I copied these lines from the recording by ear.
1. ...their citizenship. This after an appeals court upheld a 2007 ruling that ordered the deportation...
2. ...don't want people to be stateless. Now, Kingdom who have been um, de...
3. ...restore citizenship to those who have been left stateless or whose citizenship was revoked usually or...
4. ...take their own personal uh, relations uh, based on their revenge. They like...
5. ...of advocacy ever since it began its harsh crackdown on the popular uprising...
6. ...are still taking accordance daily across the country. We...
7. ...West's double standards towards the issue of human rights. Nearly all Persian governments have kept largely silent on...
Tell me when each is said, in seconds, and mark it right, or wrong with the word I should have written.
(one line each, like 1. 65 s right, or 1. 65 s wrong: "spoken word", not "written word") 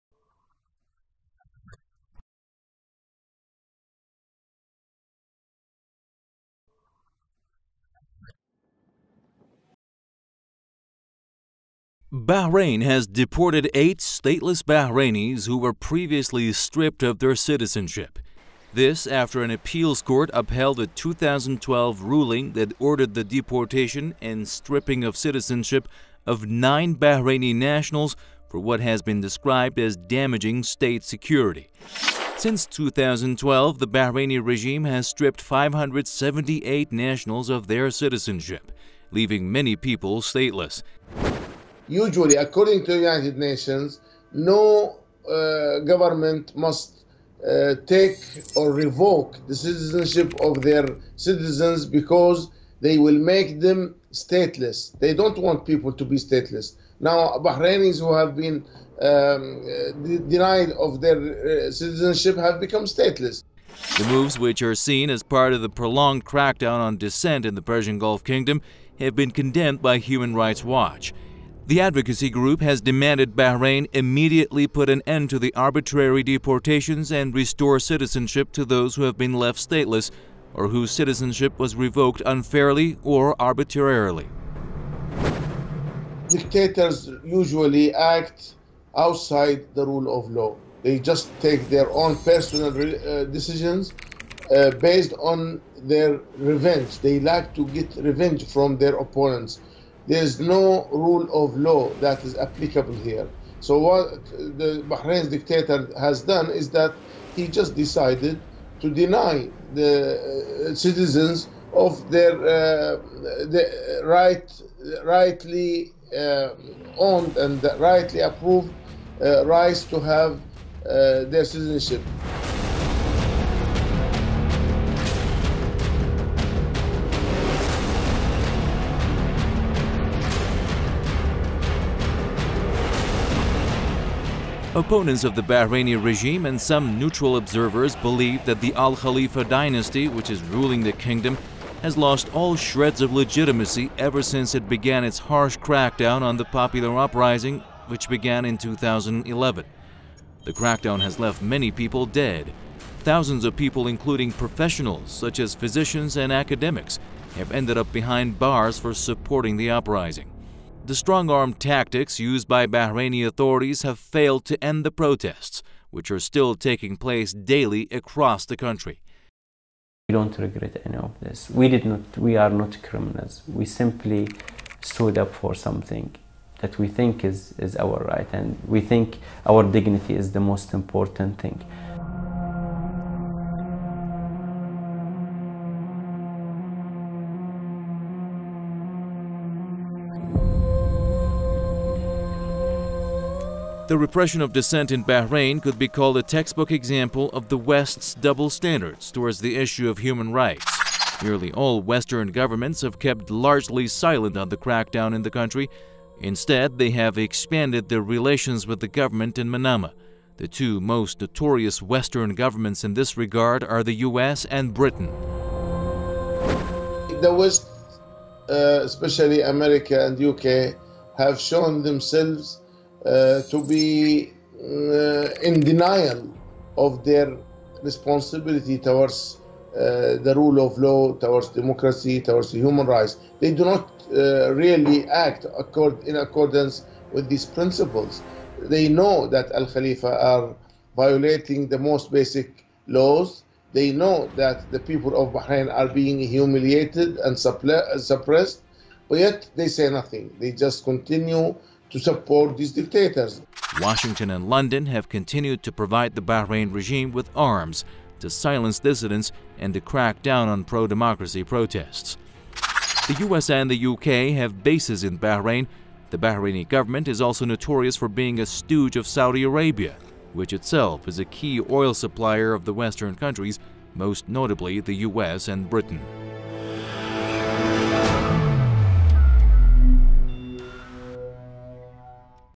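1. 17 s wrong: "2012", not "2007"
2. 55 s wrong: "Bahrainis", not "Kingdom"
3. 77 s wrong: "unfairly", not "usually"
4. 91 s wrong: "decisions", not "relations"
5. 143 s wrong: "legitimacy", not "advocacy"
6. 166 s wrong: "place", not "accordance"
7. 197 s wrong: "Western", not "Persian".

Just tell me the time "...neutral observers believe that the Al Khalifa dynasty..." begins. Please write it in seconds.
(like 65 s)
136 s.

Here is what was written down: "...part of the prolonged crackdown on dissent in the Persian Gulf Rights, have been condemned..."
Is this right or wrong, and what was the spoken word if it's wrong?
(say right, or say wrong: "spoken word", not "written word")
wrong: "Kingdom", not "Rights".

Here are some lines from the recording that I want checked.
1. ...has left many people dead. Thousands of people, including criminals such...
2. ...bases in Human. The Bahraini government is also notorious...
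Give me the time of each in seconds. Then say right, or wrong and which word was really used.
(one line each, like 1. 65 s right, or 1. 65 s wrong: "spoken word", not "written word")
1. 151 s wrong: "professionals", not "criminals"
2. 264 s wrong: "Bahrain", not "Human".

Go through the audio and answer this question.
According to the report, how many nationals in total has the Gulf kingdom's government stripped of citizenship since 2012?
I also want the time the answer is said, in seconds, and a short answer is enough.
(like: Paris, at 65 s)
578, at 35 s.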